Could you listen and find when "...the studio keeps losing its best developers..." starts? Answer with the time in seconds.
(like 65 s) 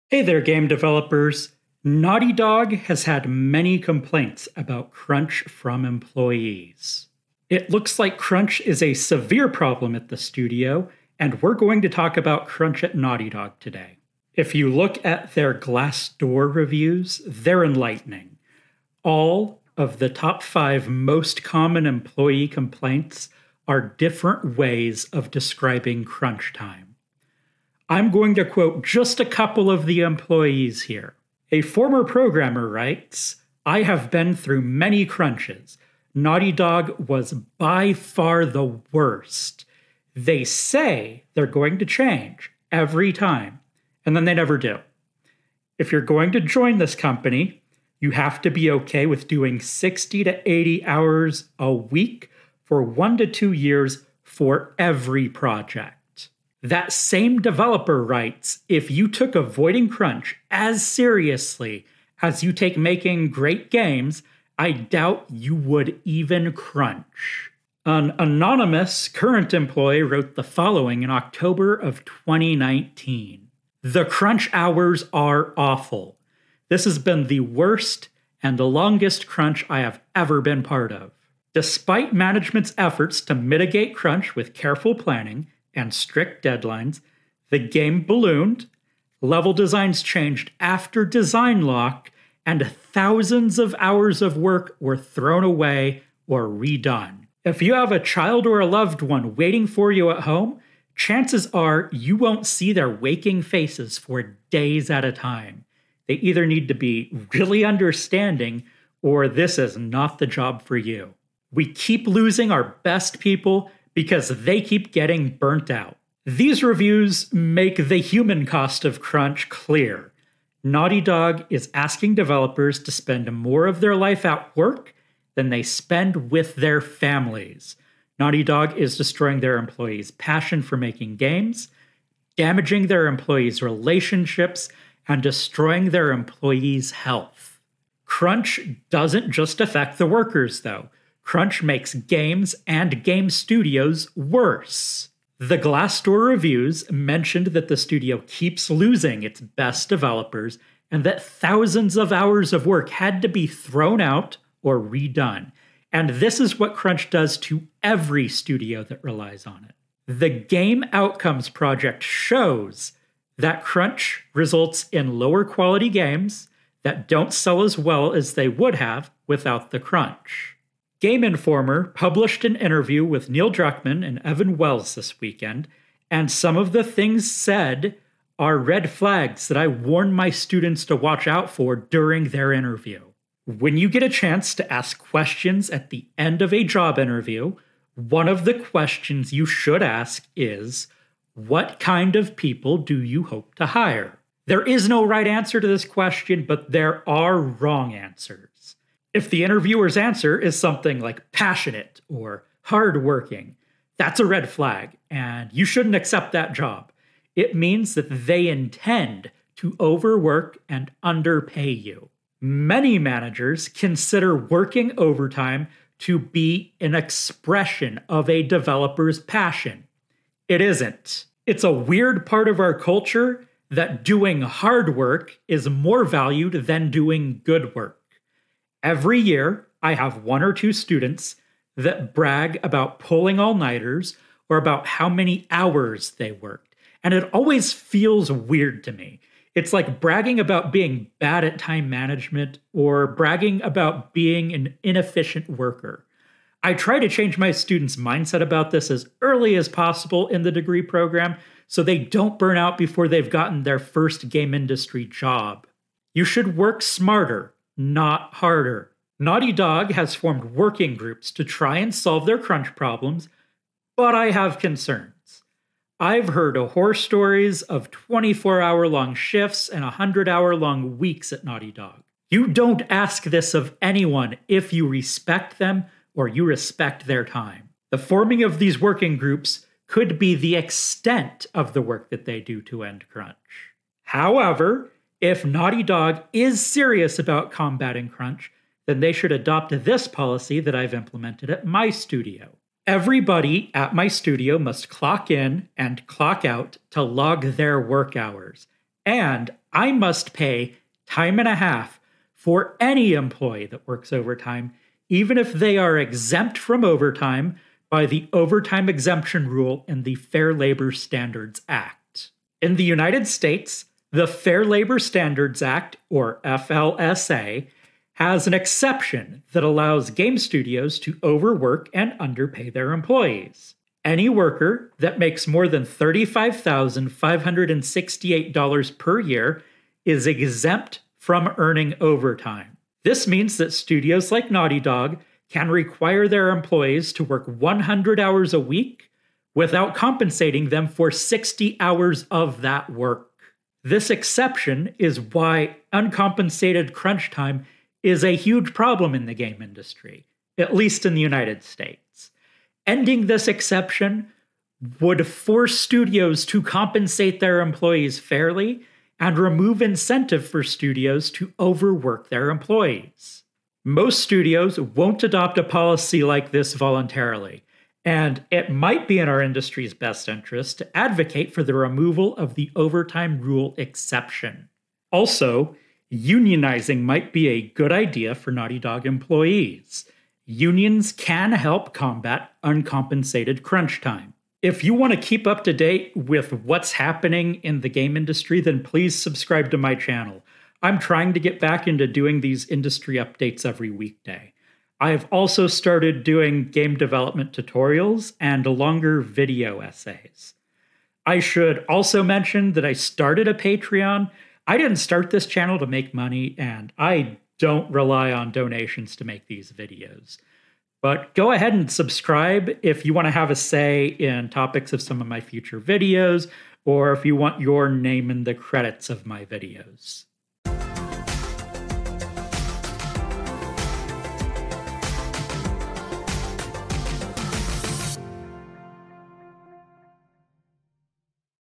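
147 s.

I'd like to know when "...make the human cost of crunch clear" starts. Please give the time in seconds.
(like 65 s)
117 s.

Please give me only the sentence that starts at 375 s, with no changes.
Also, unionizing might be a good idea for Naughty Dog employees.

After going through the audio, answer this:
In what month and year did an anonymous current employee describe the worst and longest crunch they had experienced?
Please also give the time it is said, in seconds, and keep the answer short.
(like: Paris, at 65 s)
October 2019, at 71 s.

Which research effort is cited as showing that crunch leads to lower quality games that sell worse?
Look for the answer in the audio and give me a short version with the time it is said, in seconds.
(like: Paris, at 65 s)
Game Outcomes Project, at 160 s.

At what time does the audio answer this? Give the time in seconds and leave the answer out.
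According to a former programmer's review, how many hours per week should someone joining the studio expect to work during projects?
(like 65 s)
49 s.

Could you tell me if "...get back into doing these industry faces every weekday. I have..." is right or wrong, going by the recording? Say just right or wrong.
wrong.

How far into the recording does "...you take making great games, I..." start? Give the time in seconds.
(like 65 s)
62 s.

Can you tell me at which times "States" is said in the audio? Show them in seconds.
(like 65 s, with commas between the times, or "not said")
313 s, 351 s.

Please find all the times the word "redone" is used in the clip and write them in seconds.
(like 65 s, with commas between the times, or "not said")
96 s, 154 s.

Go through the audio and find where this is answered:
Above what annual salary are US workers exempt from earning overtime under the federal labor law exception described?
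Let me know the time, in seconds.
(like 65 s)
325 s.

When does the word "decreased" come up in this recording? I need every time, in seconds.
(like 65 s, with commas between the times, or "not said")
not said.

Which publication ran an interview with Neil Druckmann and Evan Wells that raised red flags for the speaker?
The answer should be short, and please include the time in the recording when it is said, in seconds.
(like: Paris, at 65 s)
Game Informer, at 171 s.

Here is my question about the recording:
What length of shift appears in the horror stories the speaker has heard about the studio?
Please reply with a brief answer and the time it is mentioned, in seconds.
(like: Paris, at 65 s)
24 hours, at 267 s.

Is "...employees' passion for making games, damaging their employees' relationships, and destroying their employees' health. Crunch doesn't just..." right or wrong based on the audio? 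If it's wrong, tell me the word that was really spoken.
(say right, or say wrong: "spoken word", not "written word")
right.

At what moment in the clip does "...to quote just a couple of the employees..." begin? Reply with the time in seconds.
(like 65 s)
28 s.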